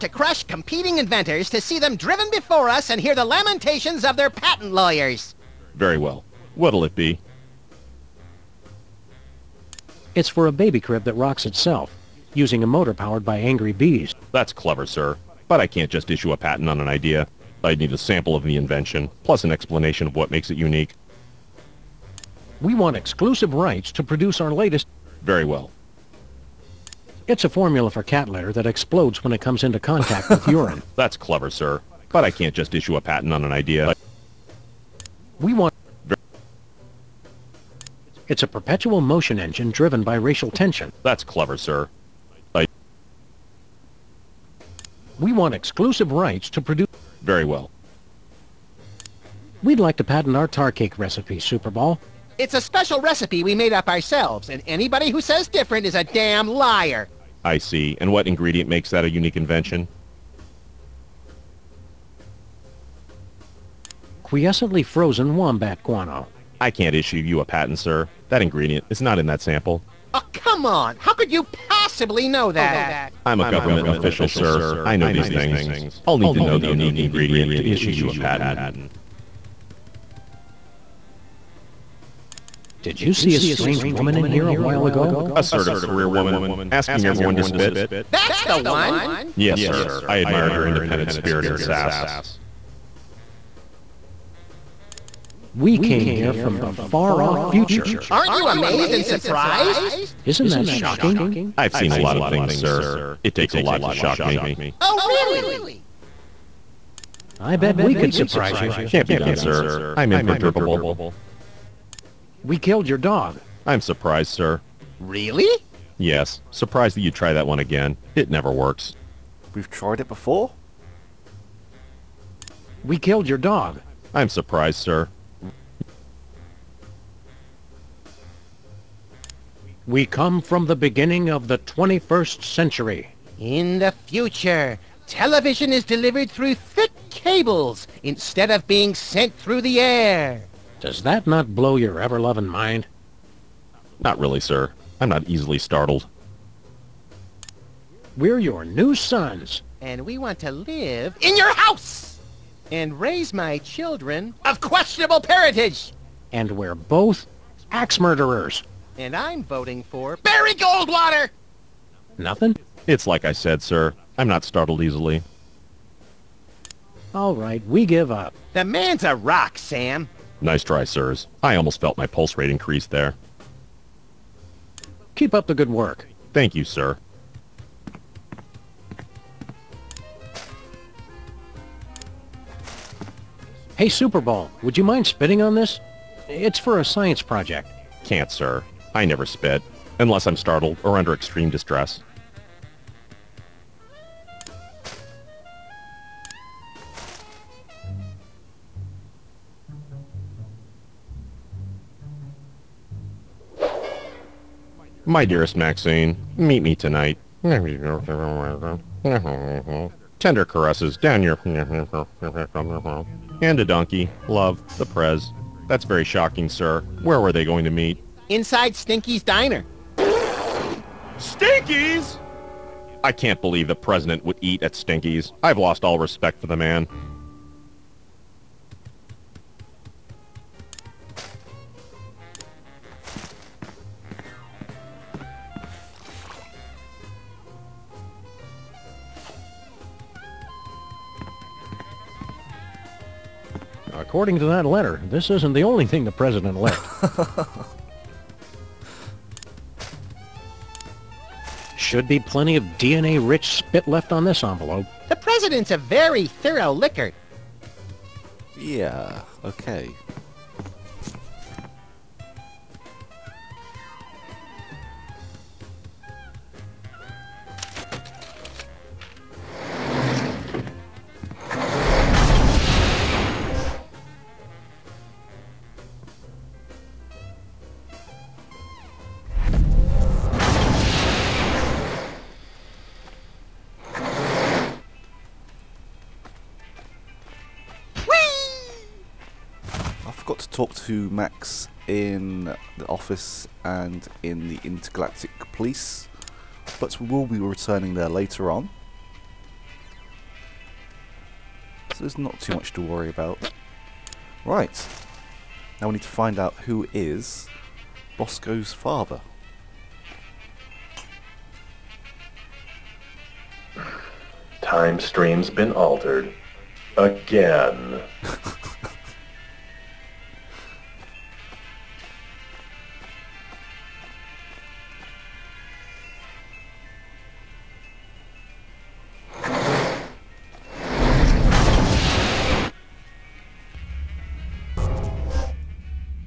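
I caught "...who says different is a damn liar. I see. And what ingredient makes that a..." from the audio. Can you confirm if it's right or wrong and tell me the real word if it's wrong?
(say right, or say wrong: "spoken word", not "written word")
right.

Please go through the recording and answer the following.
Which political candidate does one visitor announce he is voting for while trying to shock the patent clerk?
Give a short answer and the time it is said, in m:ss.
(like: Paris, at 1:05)
Barry Goldwater, at 2:40.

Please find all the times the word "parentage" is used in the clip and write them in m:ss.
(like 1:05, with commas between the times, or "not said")
2:35.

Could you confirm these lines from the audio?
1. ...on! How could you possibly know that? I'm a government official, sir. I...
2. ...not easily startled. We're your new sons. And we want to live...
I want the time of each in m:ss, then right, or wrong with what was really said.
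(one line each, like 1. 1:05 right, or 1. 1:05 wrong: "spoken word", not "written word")
1. 1:10 right
2. 2:25 right.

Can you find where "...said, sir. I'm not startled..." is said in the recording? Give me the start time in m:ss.
2:43.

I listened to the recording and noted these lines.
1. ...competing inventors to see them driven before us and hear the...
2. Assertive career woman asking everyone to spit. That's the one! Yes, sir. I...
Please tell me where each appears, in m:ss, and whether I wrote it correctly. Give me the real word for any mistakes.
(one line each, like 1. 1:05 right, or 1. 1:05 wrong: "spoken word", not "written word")
1. 0:00 right
2. 1:25 right.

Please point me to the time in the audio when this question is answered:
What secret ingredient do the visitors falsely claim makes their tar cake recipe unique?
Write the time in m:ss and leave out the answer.
1:04.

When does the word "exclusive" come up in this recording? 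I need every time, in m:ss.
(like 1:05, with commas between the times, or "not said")
0:22, 0:45.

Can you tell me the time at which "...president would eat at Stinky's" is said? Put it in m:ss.
3:43.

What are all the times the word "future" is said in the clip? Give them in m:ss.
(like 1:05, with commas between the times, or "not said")
1:37, 2:14.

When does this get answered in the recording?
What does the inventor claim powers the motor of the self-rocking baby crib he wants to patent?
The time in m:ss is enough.
0:13.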